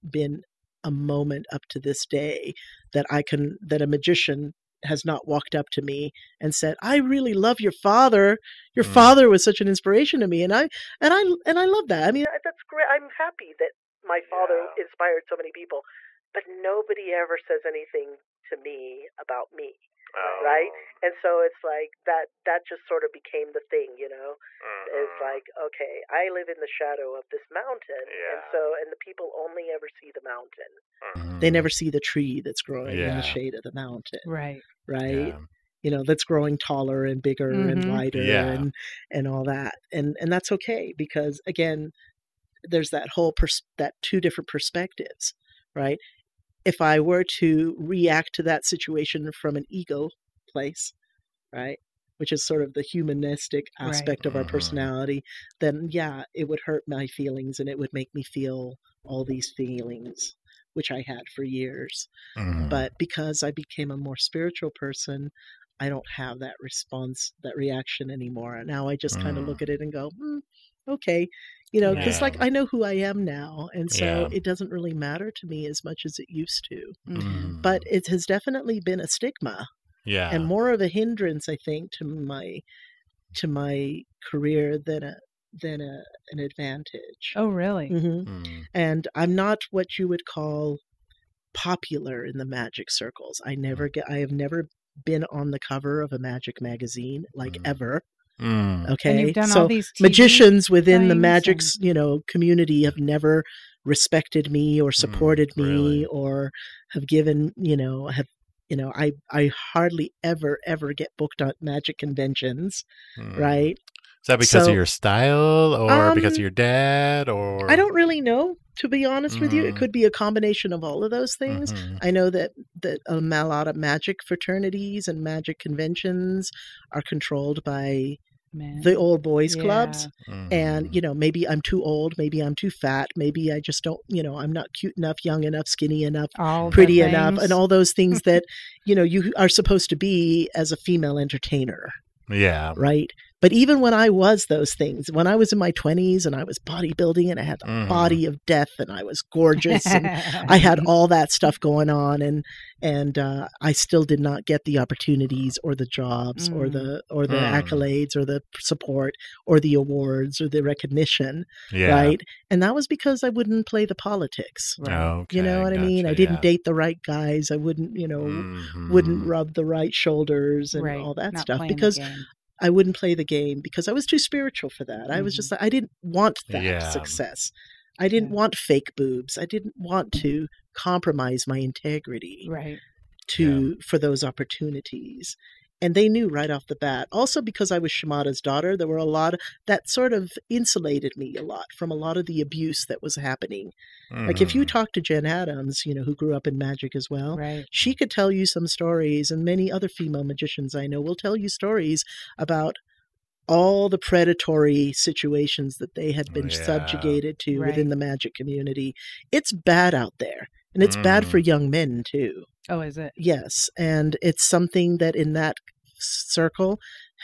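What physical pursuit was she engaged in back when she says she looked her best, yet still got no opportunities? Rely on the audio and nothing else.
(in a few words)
Bodybuilding.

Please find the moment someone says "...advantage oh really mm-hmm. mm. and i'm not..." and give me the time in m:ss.
1:26.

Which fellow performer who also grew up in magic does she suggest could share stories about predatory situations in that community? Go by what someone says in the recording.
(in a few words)
Jen Adams.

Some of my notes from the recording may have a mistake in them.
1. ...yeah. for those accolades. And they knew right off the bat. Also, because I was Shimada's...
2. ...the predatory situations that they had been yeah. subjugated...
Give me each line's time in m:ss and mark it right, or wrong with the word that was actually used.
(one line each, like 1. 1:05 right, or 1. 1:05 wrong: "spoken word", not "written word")
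1. 3:03 wrong: "opportunities", not "accolades"
2. 3:23 right.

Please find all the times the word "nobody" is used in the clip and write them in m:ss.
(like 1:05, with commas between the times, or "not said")
0:16.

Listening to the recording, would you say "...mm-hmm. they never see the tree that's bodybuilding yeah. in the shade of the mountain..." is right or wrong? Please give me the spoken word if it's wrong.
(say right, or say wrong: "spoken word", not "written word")
wrong: "growing", not "bodybuilding".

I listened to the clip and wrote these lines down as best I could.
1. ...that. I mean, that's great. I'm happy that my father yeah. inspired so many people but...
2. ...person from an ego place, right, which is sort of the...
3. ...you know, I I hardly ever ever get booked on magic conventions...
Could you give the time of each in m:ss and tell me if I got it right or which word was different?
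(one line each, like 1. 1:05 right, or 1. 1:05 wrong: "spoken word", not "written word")
1. 0:11 right
2. 0:48 wrong: "situation", not "person"
3. 1:48 right.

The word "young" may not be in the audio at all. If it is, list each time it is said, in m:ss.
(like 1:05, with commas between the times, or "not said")
2:15, 3:31.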